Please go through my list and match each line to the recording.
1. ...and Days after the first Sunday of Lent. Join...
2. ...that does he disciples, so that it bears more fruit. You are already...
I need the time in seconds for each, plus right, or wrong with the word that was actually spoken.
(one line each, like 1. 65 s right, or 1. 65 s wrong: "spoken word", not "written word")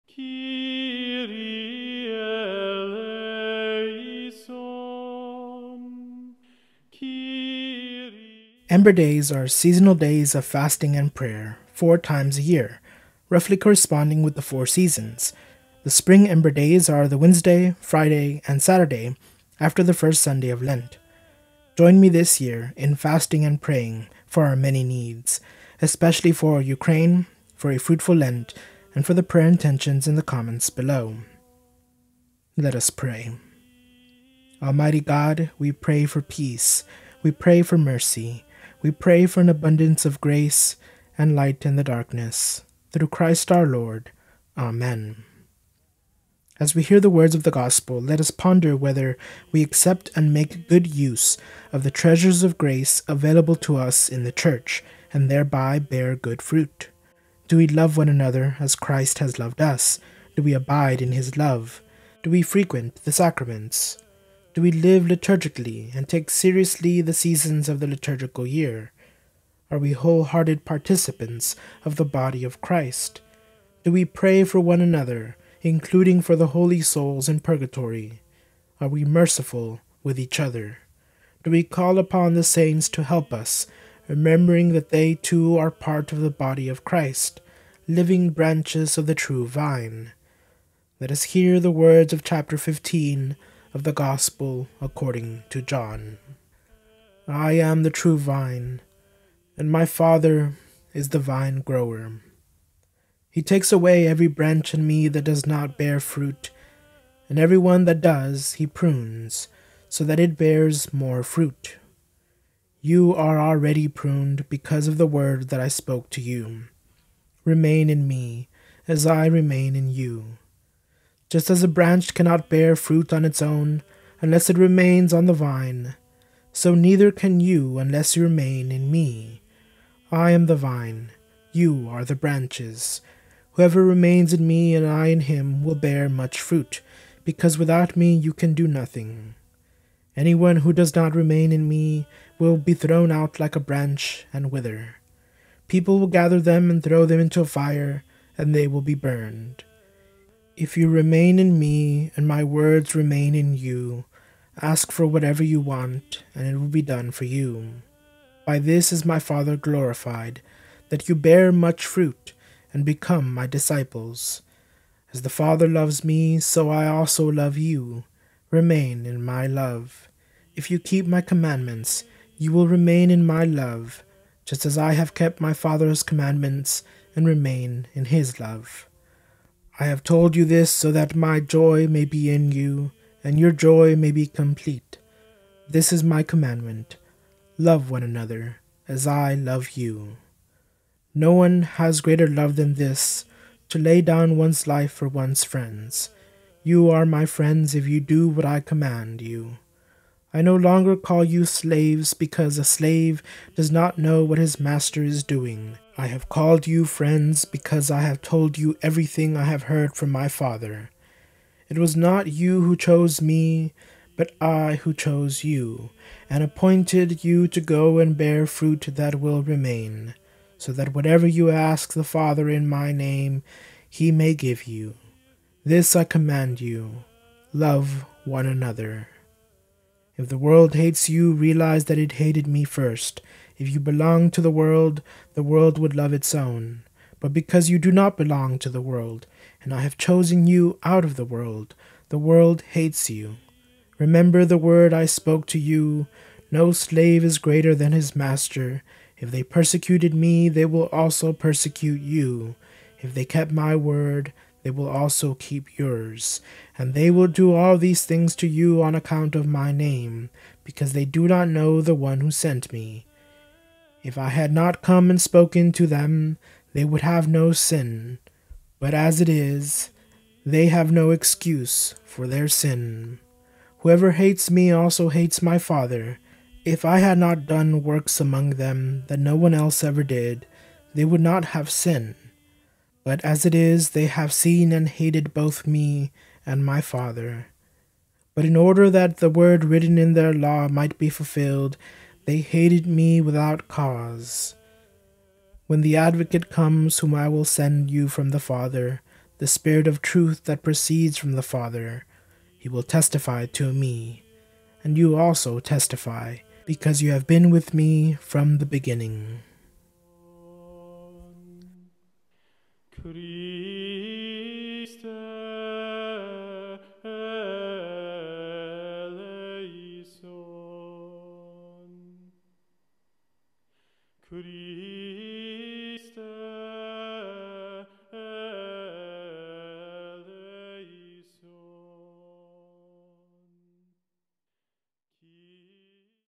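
1. 18 s wrong: "Saturday", not "Days"
2. 107 s wrong: "prunes", not "disciples".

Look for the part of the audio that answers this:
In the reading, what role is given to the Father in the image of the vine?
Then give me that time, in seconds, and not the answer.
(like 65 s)
101 s.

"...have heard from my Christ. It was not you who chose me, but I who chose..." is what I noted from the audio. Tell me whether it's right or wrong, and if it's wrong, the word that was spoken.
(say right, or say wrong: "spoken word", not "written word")
wrong: "Father", not "Christ".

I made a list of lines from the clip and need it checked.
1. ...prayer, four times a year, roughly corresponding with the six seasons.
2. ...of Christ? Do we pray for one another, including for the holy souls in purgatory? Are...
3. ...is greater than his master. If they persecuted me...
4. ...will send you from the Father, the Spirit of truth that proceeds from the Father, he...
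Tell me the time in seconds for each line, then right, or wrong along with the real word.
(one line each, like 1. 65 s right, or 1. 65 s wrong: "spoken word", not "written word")
1. 11 s wrong: "four", not "six"
2. 72 s right
3. 247 s right
4. 297 s right.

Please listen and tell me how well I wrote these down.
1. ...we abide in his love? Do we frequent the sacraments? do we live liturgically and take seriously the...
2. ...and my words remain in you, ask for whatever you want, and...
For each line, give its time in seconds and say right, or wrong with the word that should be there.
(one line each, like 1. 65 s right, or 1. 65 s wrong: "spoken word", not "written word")
1. 60 s right
2. 152 s right.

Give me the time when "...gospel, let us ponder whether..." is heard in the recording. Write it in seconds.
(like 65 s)
47 s.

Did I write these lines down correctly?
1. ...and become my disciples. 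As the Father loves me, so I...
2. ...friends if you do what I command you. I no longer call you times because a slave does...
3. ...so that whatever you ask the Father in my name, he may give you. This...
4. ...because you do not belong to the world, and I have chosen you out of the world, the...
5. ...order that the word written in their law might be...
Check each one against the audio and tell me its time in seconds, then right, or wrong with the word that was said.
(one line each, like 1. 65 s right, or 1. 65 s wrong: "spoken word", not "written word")
1. 162 s right
2. 197 s wrong: "slaves", not "times"
3. 220 s right
4. 237 s right
5. 288 s right.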